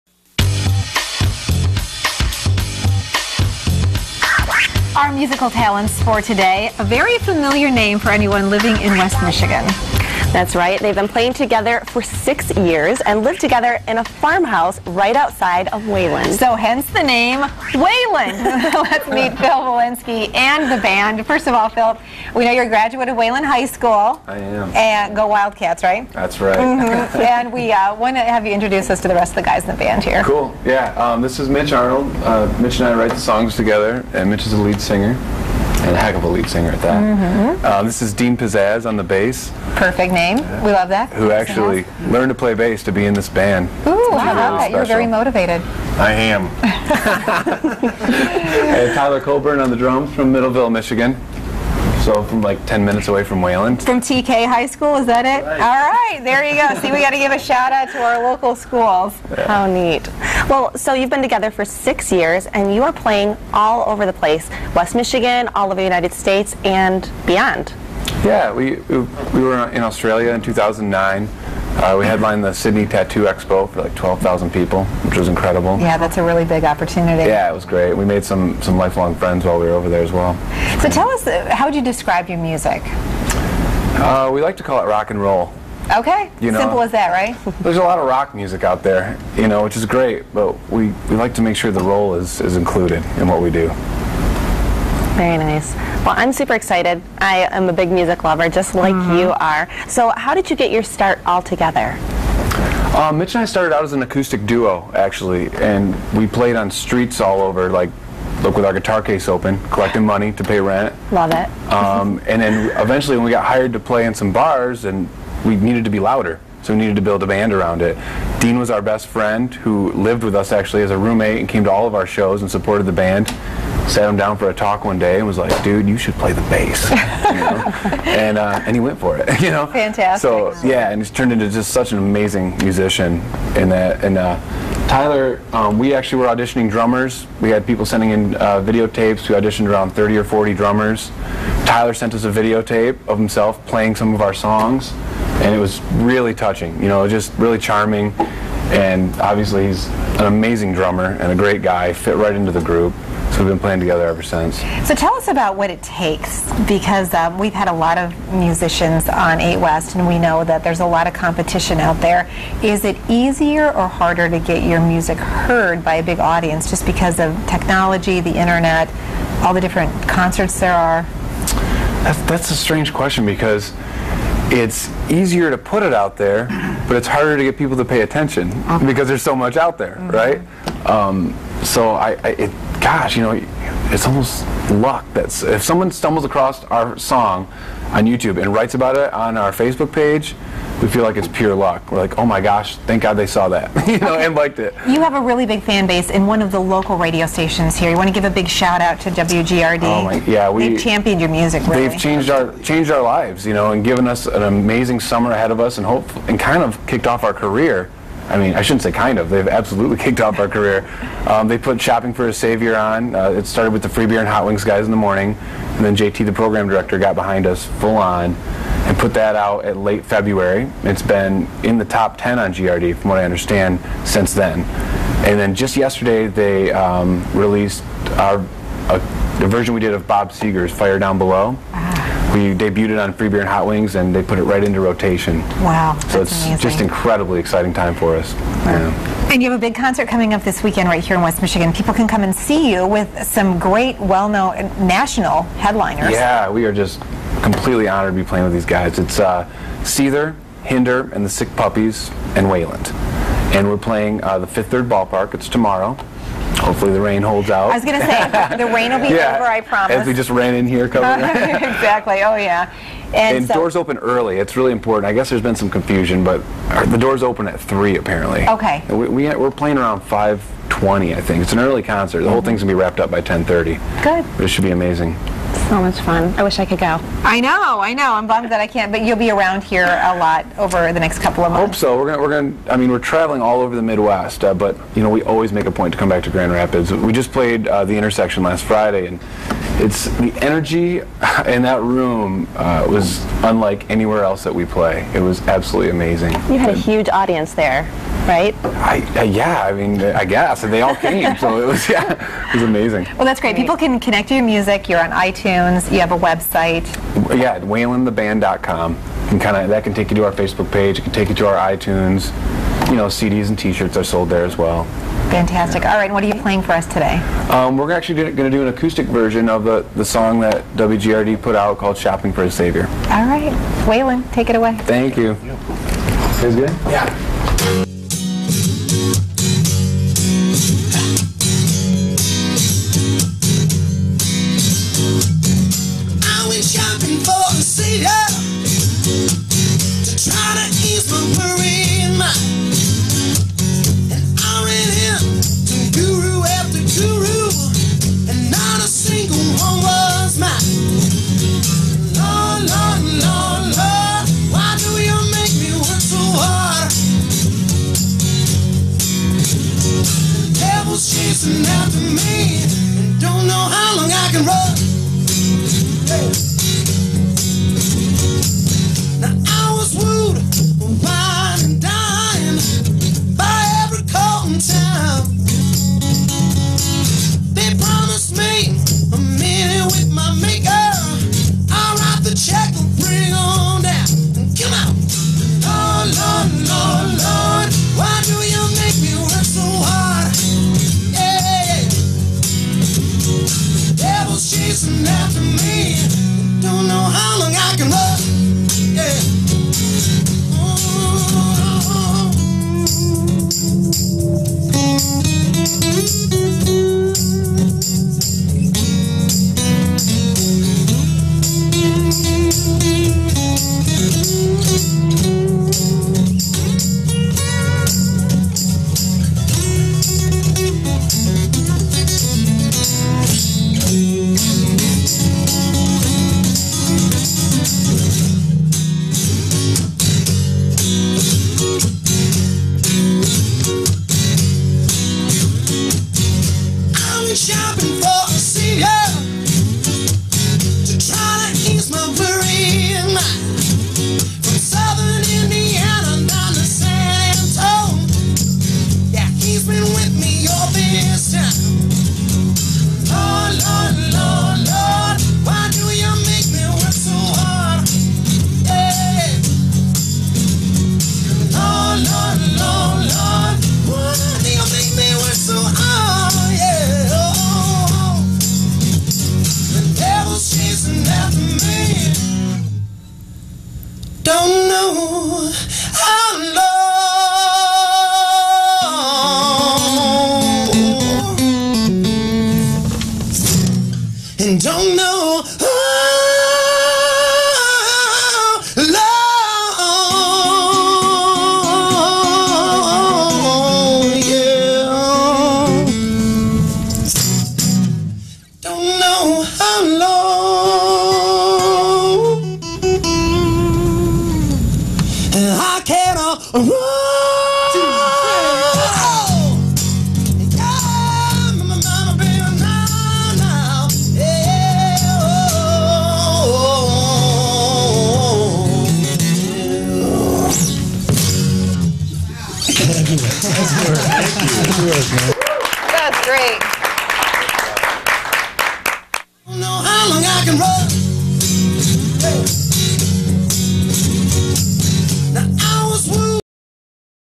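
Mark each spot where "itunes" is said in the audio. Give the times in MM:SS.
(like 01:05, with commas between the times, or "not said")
05:05, 05:11.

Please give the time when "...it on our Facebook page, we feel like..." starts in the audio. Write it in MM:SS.
03:08.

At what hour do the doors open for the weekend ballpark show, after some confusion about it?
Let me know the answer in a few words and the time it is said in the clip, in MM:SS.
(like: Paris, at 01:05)
3, at 04:27.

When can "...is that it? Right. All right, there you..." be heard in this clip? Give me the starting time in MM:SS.
00:54.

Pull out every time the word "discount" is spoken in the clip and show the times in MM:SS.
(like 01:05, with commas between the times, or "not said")
not said.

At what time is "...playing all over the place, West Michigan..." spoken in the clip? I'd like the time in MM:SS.
01:02.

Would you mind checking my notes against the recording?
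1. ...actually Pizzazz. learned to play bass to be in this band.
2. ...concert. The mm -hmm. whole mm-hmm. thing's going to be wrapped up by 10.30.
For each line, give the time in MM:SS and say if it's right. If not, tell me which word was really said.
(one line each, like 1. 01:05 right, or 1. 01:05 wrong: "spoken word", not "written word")
1. 00:41 right
2. 04:31 right.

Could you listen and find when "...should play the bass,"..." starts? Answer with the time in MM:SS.
02:05.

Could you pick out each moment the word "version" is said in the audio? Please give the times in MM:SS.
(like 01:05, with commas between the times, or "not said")
03:49, 05:19.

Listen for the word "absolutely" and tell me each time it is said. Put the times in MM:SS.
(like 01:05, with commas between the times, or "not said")
03:29, 04:55.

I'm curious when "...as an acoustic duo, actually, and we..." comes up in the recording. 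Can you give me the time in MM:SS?
01:43.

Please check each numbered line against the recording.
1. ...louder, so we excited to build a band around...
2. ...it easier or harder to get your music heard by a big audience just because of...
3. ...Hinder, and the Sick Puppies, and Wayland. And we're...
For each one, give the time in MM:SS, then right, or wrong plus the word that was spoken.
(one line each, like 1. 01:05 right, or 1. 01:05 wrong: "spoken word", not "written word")
1. 01:55 wrong: "needed", not "excited"
2. 02:42 right
3. 04:10 right.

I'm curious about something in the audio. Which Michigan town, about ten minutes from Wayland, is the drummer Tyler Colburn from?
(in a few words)
Middleville.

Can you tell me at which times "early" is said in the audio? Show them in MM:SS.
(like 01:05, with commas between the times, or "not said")
04:23, 04:31.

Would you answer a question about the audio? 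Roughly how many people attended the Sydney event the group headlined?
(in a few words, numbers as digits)
12,000.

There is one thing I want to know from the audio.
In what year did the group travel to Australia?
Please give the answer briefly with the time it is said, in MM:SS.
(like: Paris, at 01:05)
2009, at 01:10.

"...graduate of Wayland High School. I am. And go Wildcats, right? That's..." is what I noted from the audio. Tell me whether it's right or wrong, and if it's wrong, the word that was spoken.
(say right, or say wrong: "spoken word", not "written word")
right.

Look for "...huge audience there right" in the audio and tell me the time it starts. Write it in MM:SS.
04:56.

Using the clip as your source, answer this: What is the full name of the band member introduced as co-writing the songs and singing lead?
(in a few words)
Mitch Arnold.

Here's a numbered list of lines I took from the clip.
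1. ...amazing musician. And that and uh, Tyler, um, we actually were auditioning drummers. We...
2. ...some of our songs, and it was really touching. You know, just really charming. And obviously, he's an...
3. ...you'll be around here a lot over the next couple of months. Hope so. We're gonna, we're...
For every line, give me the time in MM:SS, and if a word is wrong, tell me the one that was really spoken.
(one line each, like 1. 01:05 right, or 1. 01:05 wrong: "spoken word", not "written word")
1. 02:11 right
2. 02:23 right
3. 04:39 right.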